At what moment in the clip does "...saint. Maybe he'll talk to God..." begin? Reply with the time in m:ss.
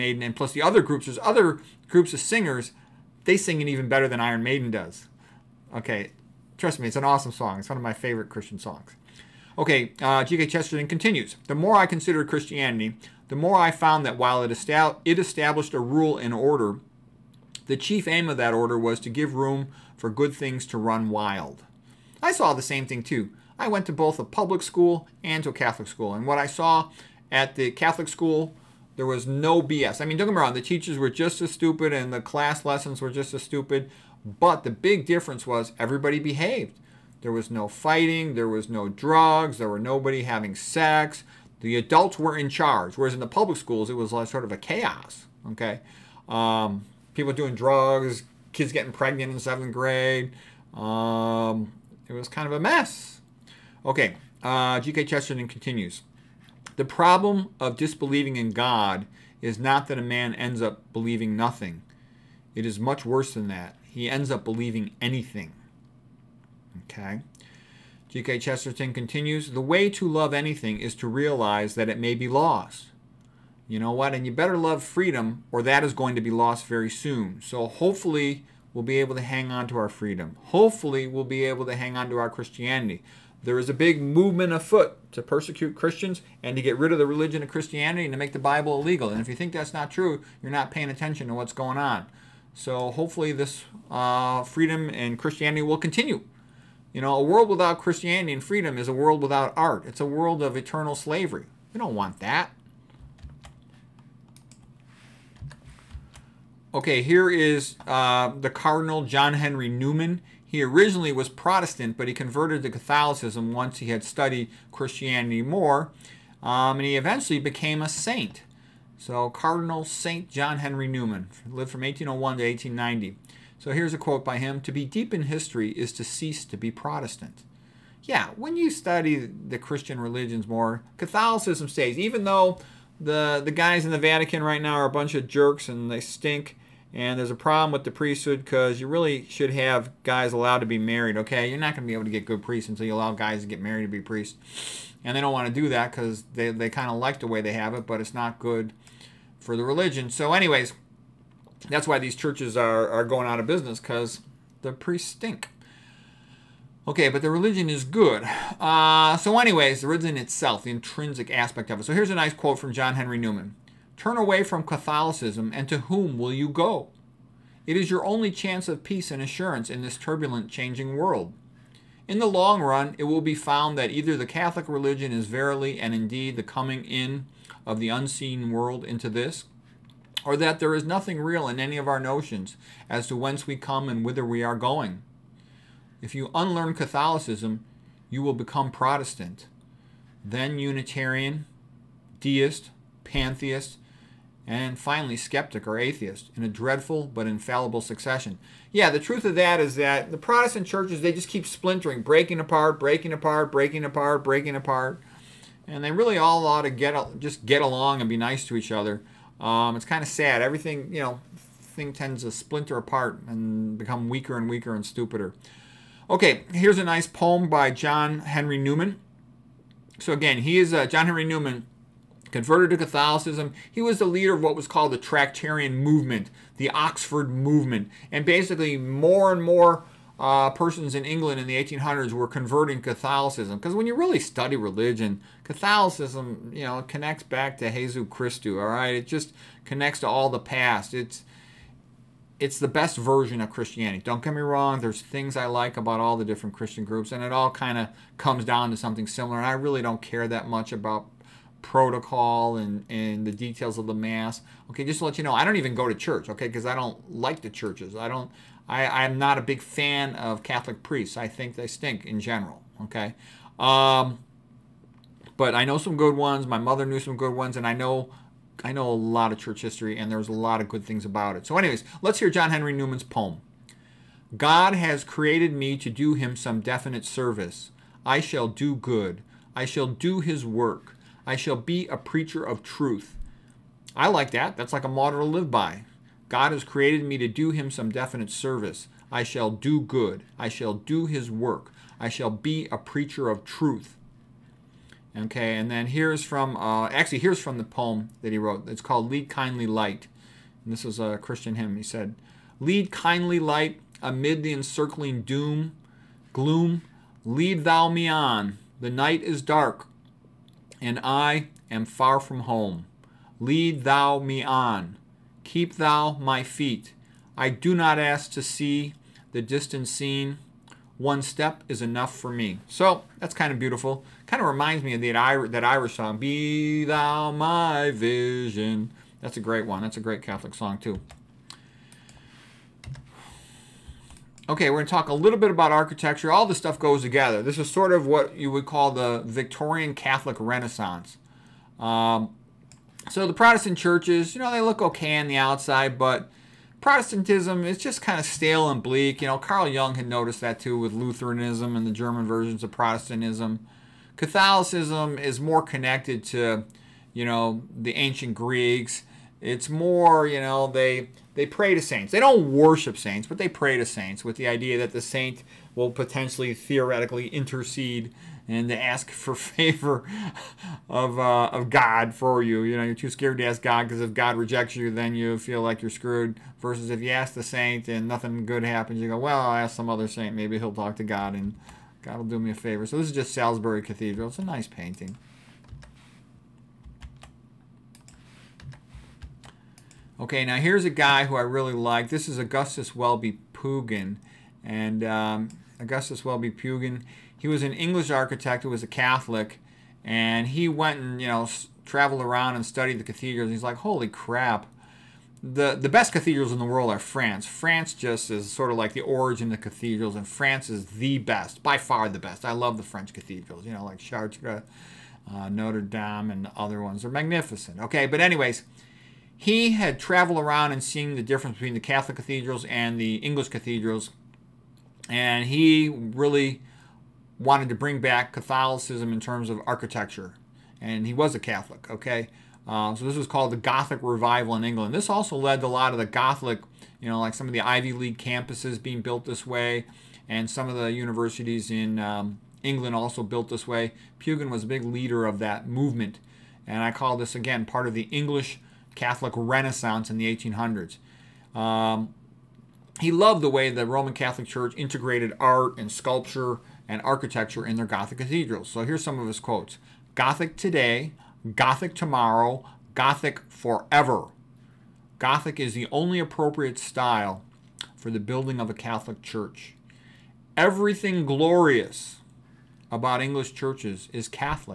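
6:20.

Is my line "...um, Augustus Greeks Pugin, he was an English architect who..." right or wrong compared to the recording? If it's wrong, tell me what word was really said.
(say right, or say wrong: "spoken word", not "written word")
wrong: "Welby", not "Greeks".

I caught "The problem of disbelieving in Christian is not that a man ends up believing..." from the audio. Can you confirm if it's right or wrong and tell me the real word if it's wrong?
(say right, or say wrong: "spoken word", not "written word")
wrong: "God", not "Christian".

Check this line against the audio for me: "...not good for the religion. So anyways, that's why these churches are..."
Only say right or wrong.
right.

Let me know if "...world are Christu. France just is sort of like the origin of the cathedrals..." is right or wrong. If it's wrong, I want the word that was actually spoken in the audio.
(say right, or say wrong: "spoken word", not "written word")
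wrong: "France", not "Christu".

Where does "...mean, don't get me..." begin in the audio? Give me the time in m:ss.
0:30.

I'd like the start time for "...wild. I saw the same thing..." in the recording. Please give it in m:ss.
0:21.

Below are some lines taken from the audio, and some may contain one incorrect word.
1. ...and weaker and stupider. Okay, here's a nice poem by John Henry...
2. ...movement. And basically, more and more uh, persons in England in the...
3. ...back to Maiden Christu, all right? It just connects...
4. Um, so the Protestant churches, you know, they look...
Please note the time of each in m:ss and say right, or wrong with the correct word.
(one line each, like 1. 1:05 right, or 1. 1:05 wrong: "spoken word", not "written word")
1. 3:34 right
2. 3:47 right
3. 3:57 wrong: "Jesus", not "Maiden"
4. 5:41 right.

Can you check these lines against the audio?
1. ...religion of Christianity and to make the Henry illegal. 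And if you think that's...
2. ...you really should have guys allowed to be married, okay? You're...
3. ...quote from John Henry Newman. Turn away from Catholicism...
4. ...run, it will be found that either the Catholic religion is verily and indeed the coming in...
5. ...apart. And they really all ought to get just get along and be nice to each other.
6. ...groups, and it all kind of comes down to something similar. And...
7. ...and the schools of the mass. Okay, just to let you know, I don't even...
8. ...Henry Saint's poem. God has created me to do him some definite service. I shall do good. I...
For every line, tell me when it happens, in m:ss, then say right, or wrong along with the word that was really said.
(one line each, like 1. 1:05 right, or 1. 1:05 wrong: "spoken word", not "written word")
1. 1:27 wrong: "Bible", not "Henry"
2. 2:18 right
3. 2:42 right
4. 2:52 right
5. 3:24 right
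6. 4:06 right
7. 4:12 wrong: "details", not "schools"
8. 4:32 wrong: "Newman", not "Saint".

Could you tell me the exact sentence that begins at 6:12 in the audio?
You know, you're too scared to ask God because if God rejects you, then you feel like you're screwed.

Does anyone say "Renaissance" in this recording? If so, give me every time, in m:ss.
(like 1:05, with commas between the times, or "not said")
5:40, 7:29.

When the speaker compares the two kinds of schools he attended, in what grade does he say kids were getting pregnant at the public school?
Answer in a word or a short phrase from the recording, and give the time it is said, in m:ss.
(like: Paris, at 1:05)
Seventh grade, at 0:49.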